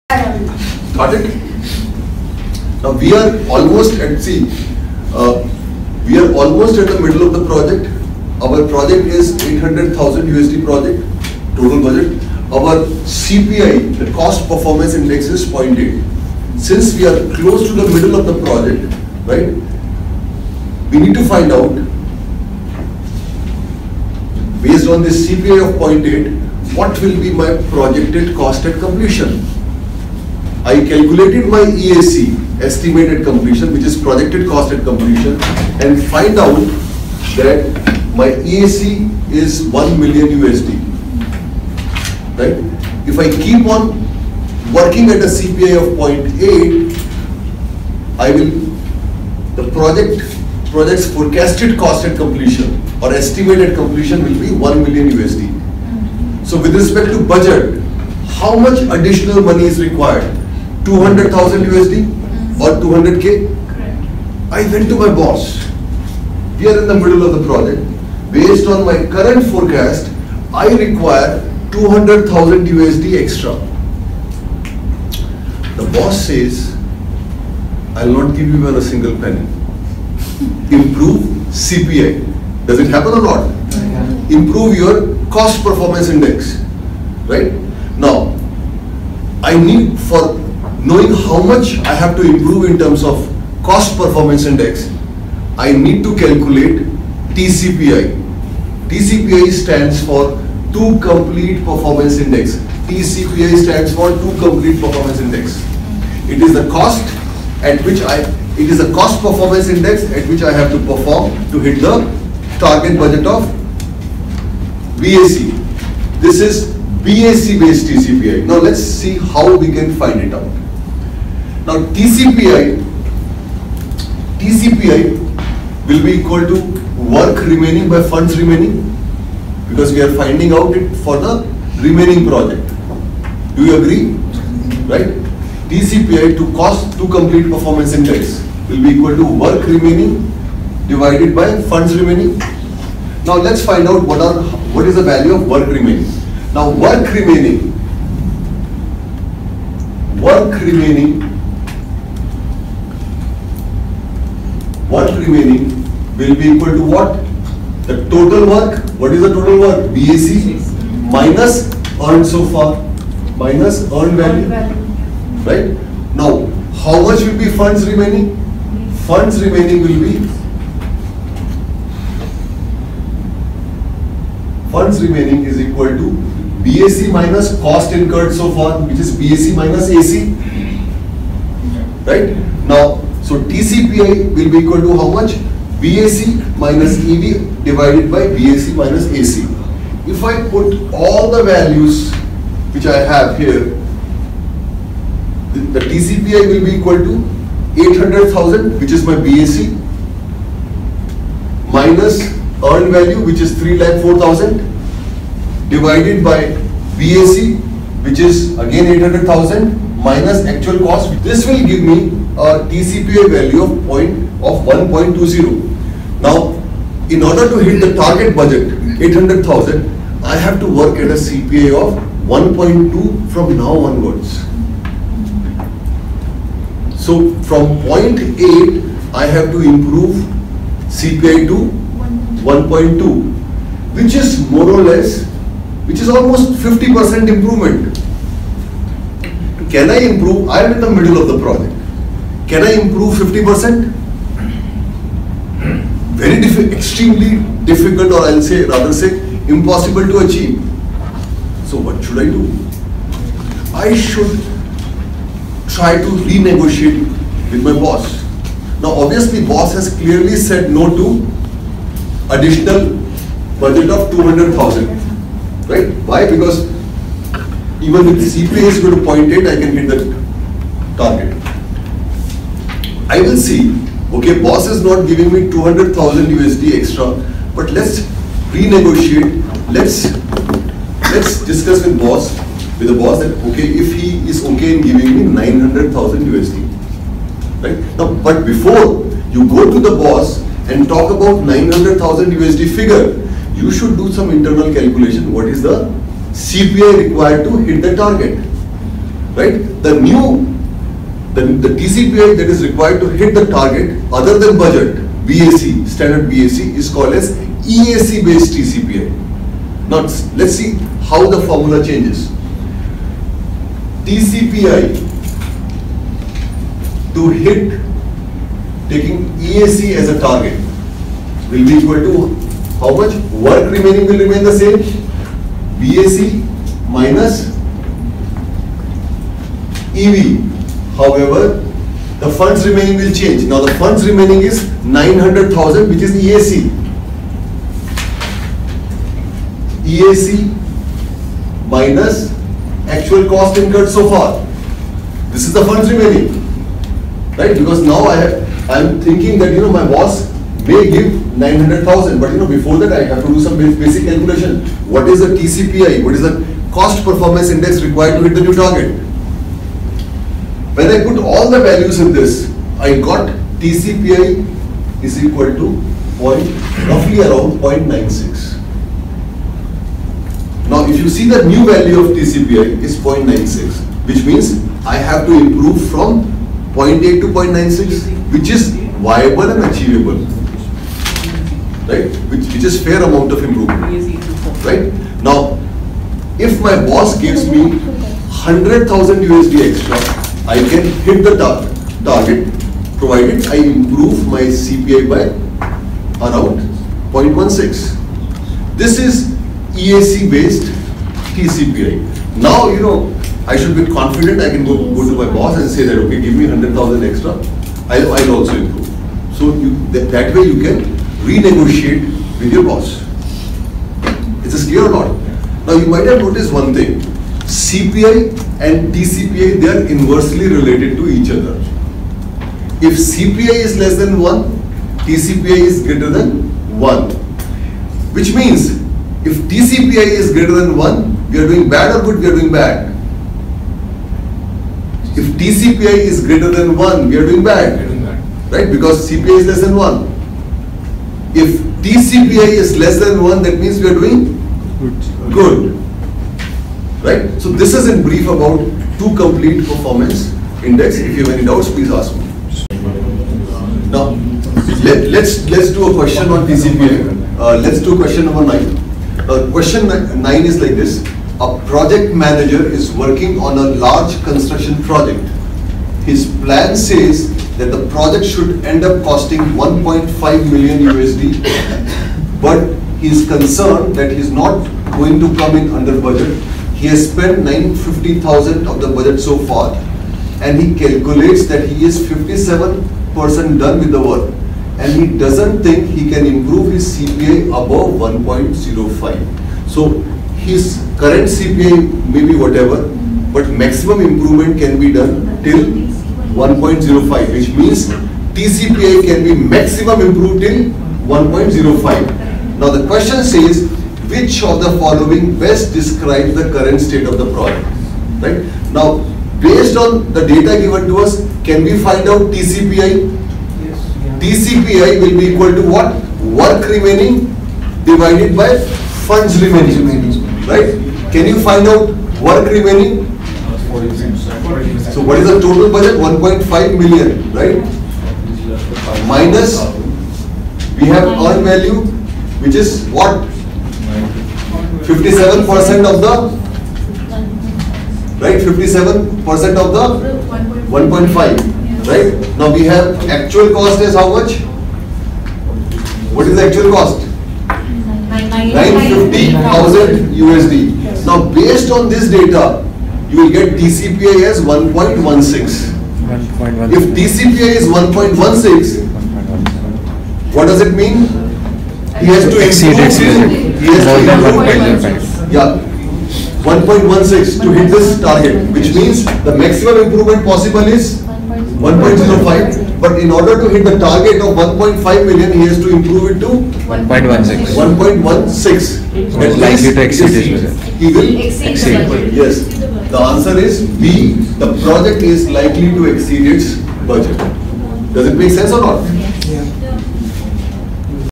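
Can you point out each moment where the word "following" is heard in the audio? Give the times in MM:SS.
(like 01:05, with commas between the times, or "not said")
08:24.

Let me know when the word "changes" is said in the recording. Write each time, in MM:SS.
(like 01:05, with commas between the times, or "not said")
05:11, 05:33.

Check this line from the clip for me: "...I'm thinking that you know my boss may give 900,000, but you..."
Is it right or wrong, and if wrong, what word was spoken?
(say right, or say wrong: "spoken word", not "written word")
right.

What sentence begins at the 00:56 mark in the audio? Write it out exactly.
So with respect to budget, how much additional money is required?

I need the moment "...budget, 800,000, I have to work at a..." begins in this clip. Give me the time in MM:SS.
03:38.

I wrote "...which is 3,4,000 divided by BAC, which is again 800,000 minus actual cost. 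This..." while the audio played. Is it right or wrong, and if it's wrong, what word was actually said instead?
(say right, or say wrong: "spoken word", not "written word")
right.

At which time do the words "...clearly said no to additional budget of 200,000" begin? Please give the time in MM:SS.
04:20.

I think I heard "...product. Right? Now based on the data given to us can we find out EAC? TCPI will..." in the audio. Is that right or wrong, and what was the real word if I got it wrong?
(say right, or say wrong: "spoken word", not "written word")
wrong: "TCPI", not "EAC".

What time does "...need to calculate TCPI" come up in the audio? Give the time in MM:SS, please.
01:35.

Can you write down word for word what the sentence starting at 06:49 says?
So you, that way you can renegotiate with your boss.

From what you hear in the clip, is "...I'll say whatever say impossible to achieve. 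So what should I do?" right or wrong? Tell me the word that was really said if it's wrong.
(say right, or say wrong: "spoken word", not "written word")
wrong: "rather", not "whatever".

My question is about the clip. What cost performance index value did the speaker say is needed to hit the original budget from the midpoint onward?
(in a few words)
1.20.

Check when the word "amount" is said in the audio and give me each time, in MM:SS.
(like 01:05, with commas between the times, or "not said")
06:23.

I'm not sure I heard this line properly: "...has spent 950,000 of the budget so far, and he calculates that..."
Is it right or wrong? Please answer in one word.
right.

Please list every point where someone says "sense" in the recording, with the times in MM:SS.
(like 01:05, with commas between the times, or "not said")
09:48.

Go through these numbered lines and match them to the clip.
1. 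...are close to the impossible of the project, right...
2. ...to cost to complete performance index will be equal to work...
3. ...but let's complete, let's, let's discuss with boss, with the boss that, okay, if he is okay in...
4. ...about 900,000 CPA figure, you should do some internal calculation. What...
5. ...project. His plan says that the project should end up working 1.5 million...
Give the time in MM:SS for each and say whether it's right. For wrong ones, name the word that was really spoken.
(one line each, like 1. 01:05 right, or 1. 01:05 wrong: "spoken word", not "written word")
1. 00:17 wrong: "middle", not "impossible"
2. 02:16 right
3. 04:37 wrong: "renegotiate", not "complete"
4. 04:51 wrong: "USD", not "CPA"
5. 07:44 wrong: "costing", not "working".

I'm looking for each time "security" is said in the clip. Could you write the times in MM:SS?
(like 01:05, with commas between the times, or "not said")
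not said.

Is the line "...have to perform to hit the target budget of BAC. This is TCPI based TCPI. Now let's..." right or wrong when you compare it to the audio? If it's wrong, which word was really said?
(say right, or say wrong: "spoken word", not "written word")
wrong: "BAC", not "TCPI".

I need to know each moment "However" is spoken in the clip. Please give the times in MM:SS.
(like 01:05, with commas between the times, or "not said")
05:30.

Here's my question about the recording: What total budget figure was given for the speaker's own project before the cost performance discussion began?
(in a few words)
800,000 USD.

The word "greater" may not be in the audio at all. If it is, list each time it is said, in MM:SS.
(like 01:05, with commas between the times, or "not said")
07:05, 07:10, 07:16.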